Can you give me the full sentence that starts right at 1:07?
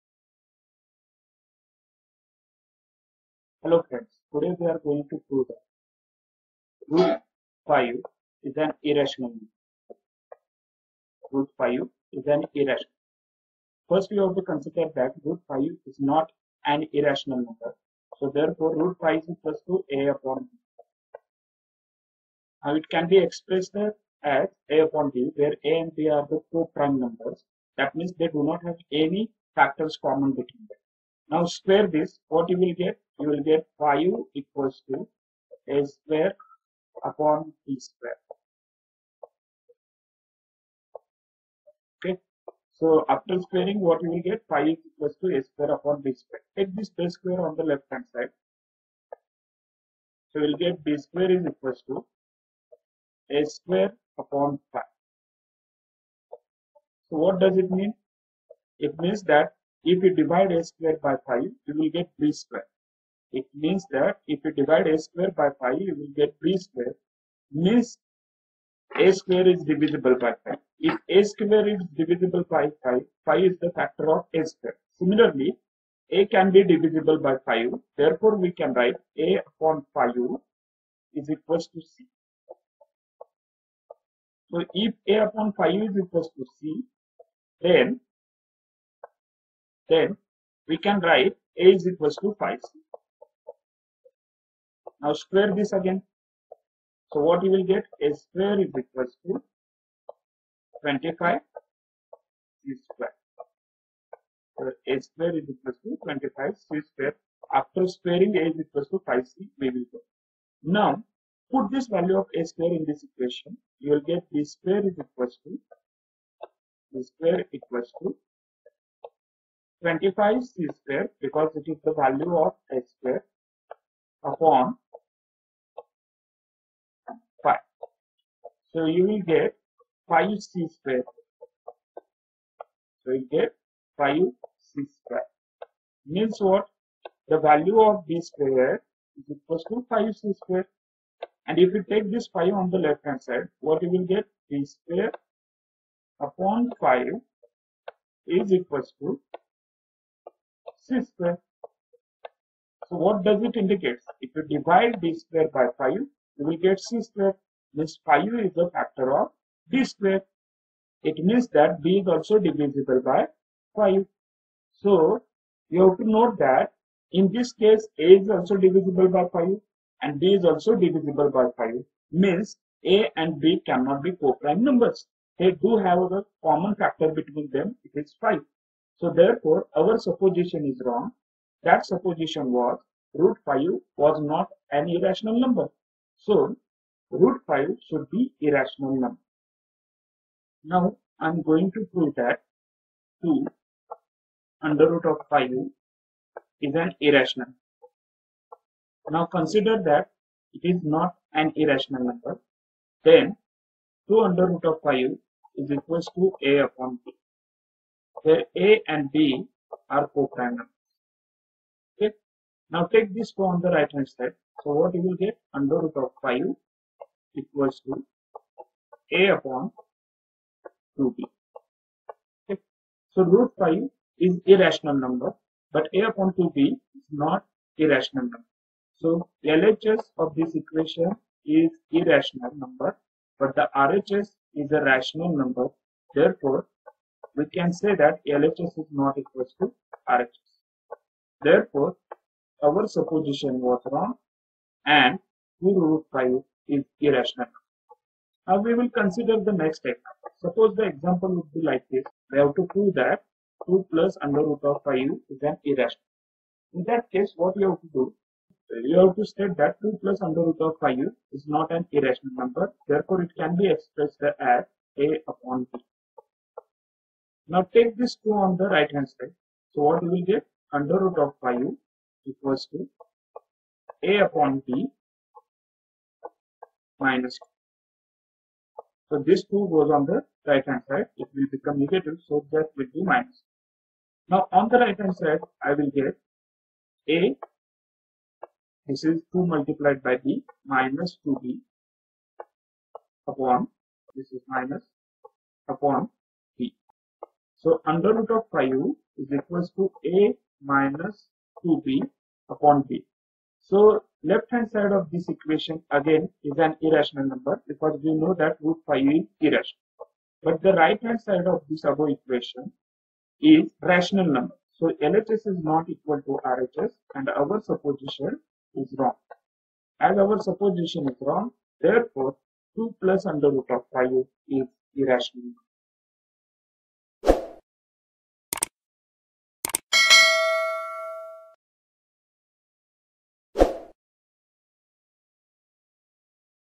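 Means a square is divisible by 5.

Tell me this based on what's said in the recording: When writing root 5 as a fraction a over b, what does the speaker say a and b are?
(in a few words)
prime numbers.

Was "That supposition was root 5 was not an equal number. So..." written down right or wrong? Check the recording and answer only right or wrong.
wrong.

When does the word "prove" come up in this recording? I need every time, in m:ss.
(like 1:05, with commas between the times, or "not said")
0:05, 3:11, 4:12.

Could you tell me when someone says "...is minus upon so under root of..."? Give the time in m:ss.
4:54.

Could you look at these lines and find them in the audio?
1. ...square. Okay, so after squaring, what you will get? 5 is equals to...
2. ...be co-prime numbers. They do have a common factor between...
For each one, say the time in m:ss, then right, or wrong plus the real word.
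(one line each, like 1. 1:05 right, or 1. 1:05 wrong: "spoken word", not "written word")
1. 0:37 right
2. 2:54 right.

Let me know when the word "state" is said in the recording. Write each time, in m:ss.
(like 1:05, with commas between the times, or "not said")
4:19.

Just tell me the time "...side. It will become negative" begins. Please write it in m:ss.
4:40.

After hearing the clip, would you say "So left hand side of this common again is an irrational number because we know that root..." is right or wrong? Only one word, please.
wrong.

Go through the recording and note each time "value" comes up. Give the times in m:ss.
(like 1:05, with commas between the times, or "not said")
1:51, 2:01, 2:17.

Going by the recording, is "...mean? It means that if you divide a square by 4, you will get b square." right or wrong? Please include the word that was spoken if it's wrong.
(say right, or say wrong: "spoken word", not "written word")
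wrong: "5", not "4".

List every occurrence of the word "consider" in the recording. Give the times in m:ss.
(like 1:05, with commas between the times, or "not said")
0:14, 3:19, 4:08.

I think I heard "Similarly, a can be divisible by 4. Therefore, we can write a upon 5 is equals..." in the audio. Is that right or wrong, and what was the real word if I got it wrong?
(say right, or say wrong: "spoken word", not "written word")
wrong: "5", not "4".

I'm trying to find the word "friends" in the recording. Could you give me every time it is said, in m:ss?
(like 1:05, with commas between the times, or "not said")
0:03.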